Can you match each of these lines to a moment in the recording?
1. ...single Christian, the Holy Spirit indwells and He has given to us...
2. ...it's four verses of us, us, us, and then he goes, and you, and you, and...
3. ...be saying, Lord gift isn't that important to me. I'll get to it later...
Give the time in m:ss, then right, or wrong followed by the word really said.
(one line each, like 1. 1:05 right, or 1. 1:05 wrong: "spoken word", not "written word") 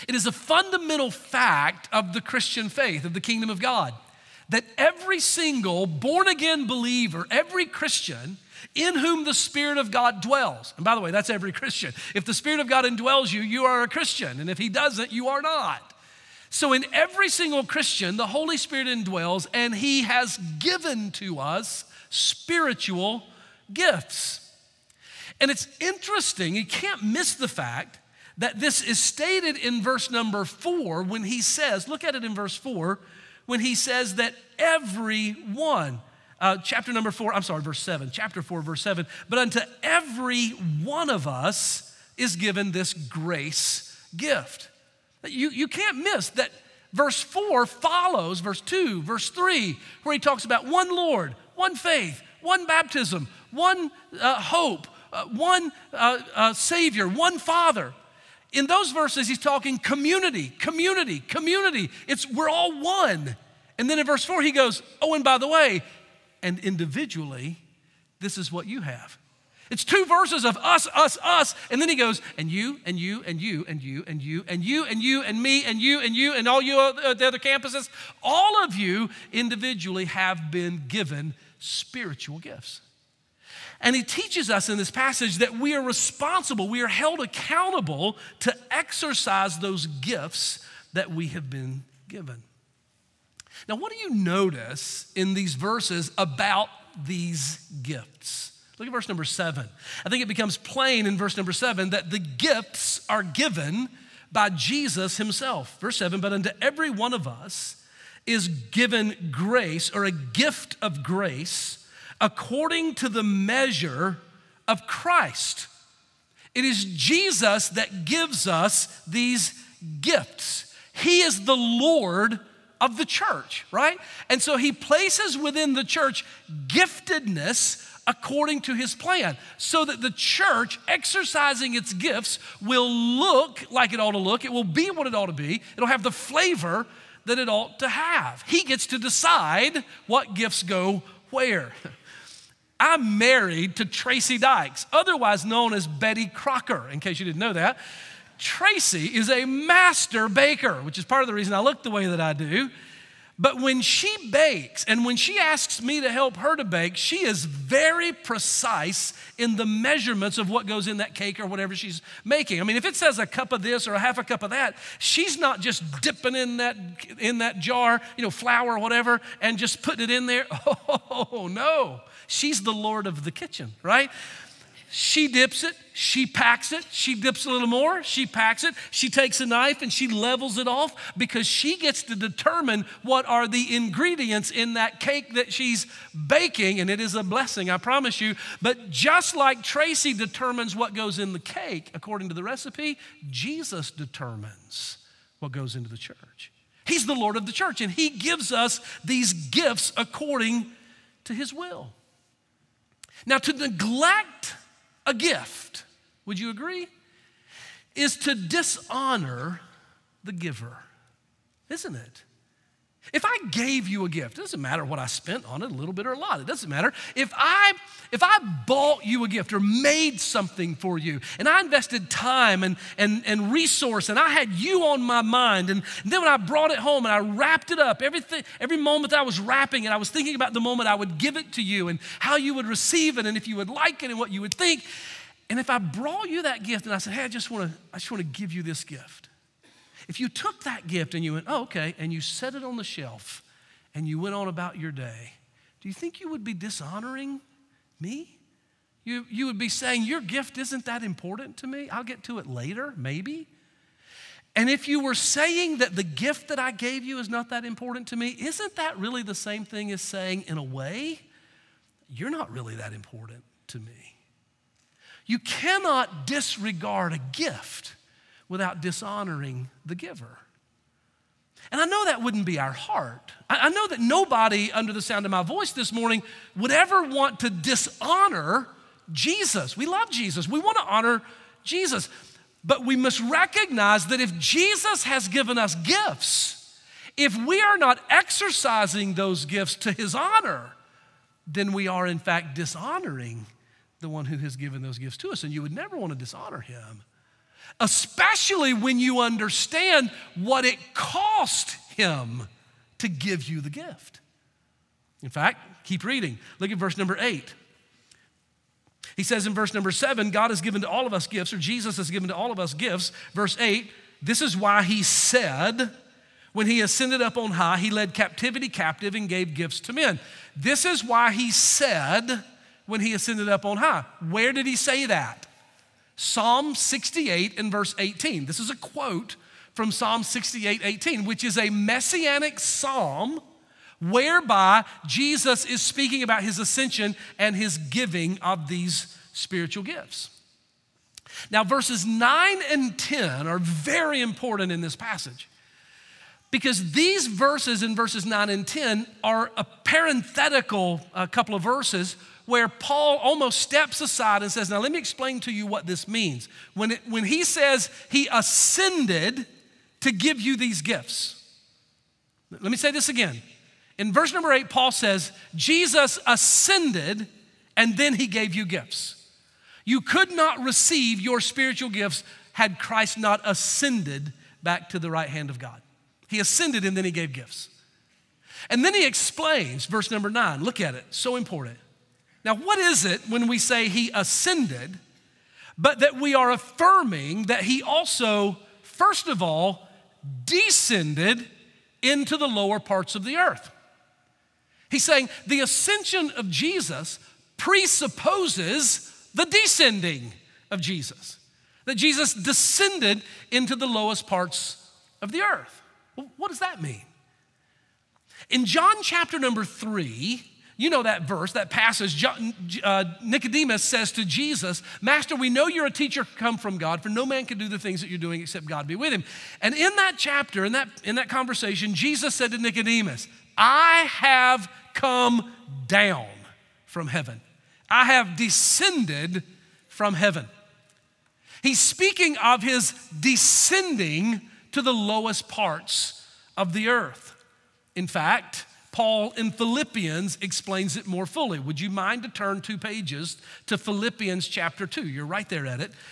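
1. 0:17 right
2. 1:09 wrong: "two", not "four"
3. 4:09 wrong: "Your", not "Lord".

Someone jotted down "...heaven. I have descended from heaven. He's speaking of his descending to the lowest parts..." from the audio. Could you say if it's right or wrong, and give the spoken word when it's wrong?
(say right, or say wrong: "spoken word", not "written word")
right.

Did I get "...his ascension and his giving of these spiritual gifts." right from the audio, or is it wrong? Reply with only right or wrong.
right.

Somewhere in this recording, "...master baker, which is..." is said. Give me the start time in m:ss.
2:29.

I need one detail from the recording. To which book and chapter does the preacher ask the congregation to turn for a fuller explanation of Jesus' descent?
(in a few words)
Philippians 2.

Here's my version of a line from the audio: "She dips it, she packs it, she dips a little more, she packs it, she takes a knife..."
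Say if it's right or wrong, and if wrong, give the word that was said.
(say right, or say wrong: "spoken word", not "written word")
right.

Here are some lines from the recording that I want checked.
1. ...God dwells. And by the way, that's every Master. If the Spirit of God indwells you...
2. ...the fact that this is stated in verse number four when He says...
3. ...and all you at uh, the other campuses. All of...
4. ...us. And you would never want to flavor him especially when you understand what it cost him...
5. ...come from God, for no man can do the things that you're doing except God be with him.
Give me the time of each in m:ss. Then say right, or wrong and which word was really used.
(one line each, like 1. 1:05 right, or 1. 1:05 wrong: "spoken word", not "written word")
1. 0:09 wrong: "Christian", not "Master"
2. 0:27 right
3. 1:16 right
4. 4:55 wrong: "dishonor", not "flavor"
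5. 6:56 right.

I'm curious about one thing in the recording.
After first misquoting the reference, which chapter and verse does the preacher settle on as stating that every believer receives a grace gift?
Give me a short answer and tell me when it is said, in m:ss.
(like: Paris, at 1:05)
Chapter 4, verse 7, at 0:37.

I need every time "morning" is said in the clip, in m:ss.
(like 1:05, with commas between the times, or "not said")
4:35.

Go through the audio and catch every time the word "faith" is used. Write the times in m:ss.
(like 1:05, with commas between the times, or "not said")
0:02, 0:51.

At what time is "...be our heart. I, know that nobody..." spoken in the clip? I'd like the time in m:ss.
4:32.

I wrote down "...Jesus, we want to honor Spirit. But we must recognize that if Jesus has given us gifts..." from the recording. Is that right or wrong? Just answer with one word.
wrong.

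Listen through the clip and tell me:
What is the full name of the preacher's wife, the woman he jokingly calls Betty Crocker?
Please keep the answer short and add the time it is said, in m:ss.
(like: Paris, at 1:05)
Tracy Dykes, at 2:23.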